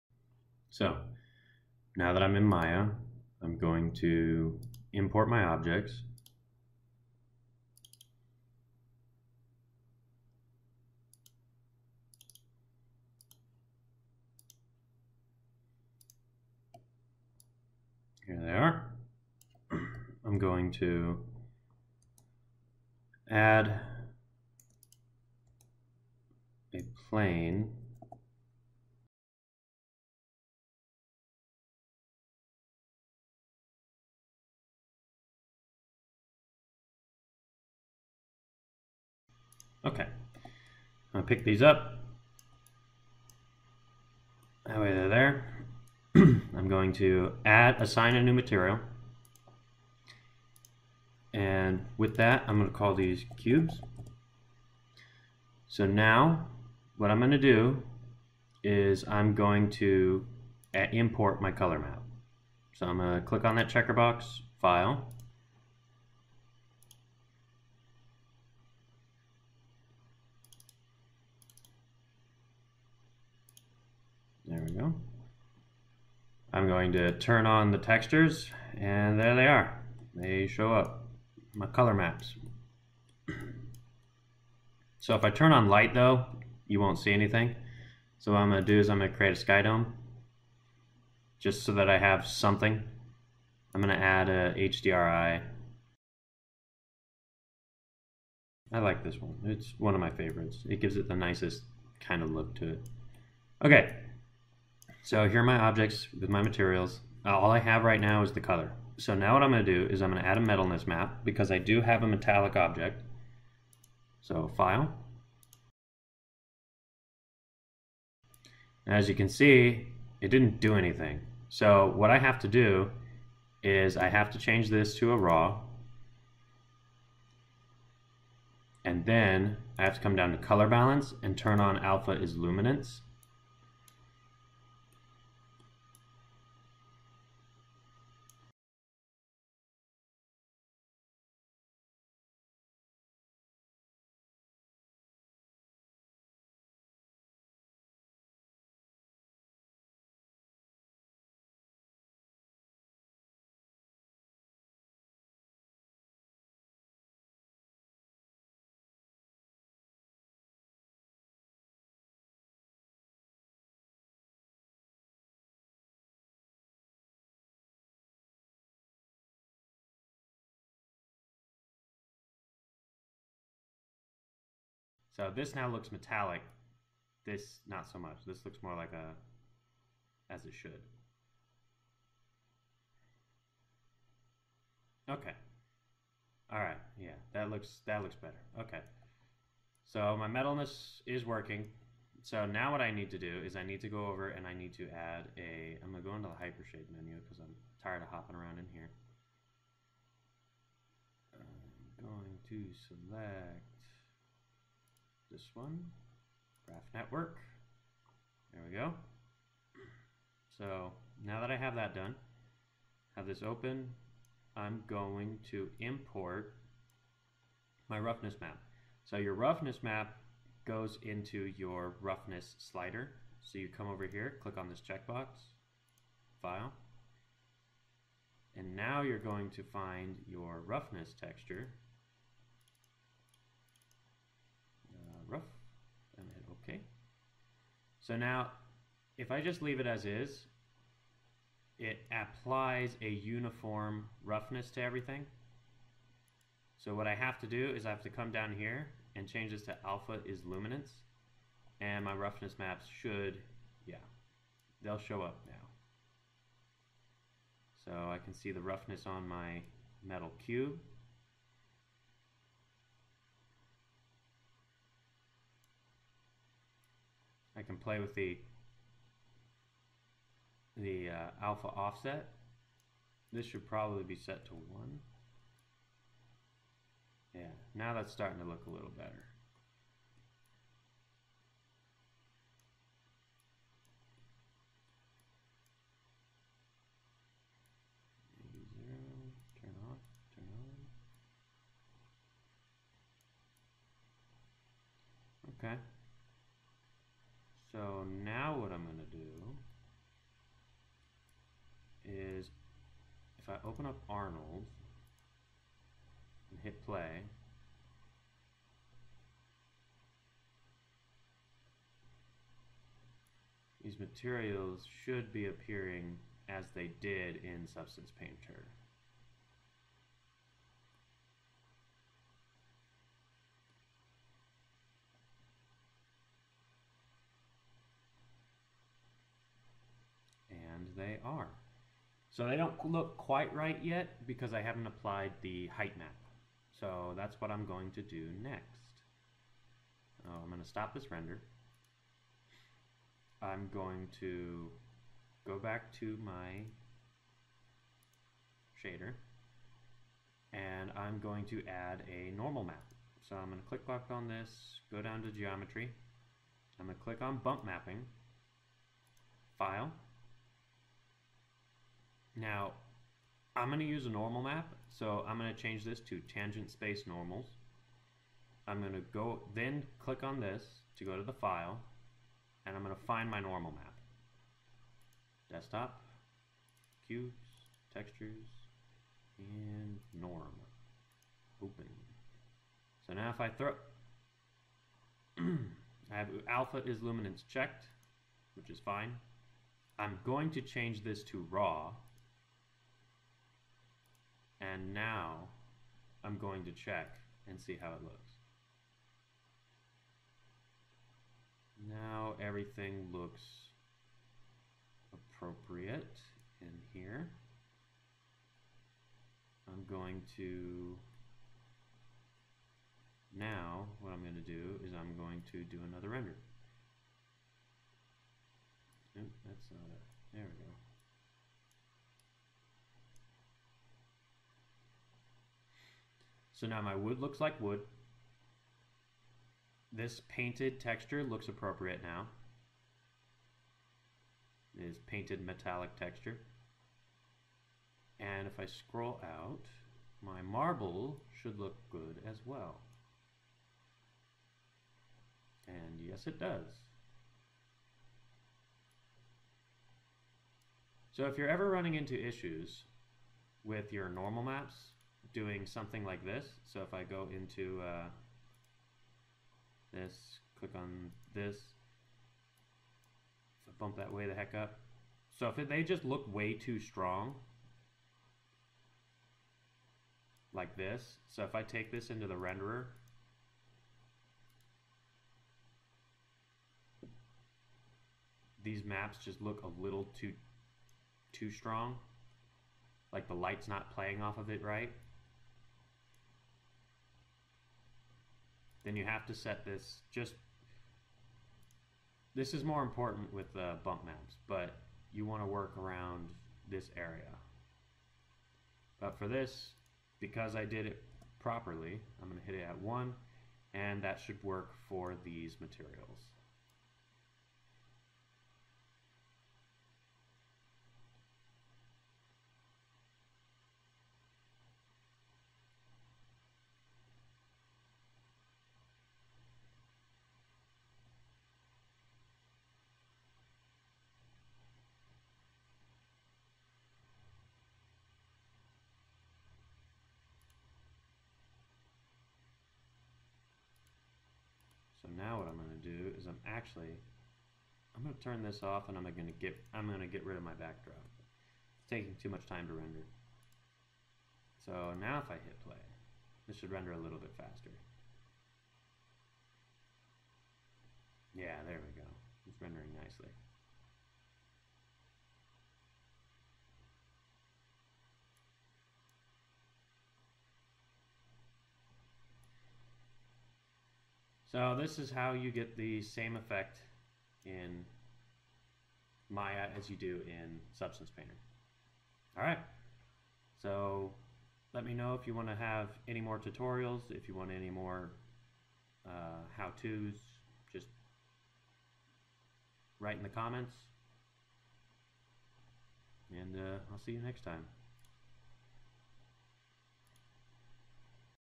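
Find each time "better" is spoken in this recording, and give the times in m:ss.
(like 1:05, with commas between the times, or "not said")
3:08, 4:38.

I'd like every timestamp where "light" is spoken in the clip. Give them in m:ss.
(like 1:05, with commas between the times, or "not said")
1:25, 8:03.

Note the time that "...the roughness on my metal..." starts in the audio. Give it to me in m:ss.
4:18.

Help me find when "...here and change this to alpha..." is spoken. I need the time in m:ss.
4:08.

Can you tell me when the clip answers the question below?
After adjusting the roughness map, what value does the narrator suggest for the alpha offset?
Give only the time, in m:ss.
4:34.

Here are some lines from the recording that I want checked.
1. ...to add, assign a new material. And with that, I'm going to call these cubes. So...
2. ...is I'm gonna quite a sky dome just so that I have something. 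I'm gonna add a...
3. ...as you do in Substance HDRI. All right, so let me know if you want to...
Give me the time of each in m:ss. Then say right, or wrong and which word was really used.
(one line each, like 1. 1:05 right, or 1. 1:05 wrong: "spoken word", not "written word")
1. 0:46 right
2. 1:28 wrong: "create", not "quite"
3. 9:29 wrong: "Painter", not "HDRI".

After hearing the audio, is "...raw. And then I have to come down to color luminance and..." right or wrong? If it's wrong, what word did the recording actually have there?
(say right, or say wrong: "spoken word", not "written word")
wrong: "balance", not "luminance".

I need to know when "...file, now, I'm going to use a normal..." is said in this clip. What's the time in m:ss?
5:59.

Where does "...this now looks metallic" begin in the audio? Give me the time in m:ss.
2:55.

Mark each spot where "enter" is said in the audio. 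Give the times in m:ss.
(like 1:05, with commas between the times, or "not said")
not said.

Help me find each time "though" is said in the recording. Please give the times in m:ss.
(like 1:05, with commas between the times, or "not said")
1:25.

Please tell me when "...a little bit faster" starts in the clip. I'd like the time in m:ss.
9:06.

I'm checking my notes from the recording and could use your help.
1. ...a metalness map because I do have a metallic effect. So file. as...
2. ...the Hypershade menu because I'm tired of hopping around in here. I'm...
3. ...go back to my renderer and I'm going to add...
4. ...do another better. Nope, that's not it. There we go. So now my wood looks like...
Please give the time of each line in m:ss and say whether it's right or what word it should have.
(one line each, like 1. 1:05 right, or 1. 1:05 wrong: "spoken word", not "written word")
1. 1:50 wrong: "object", not "effect"
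2. 3:16 right
3. 5:45 wrong: "shader", not "renderer"
4. 6:55 wrong: "render", not "better".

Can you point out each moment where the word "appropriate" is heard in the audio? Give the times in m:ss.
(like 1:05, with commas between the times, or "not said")
6:45, 7:11.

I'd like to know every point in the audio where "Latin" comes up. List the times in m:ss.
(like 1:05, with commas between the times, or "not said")
not said.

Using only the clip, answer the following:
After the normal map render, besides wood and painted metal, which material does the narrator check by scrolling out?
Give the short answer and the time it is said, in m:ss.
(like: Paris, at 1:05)
marble, at 7:20.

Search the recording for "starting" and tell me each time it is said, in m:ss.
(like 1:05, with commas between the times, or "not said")
4:38.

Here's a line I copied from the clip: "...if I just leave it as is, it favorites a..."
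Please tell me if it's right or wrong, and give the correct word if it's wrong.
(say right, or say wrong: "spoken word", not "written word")
wrong: "applies", not "favorites".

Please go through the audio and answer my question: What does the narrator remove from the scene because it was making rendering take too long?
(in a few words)
backdrop.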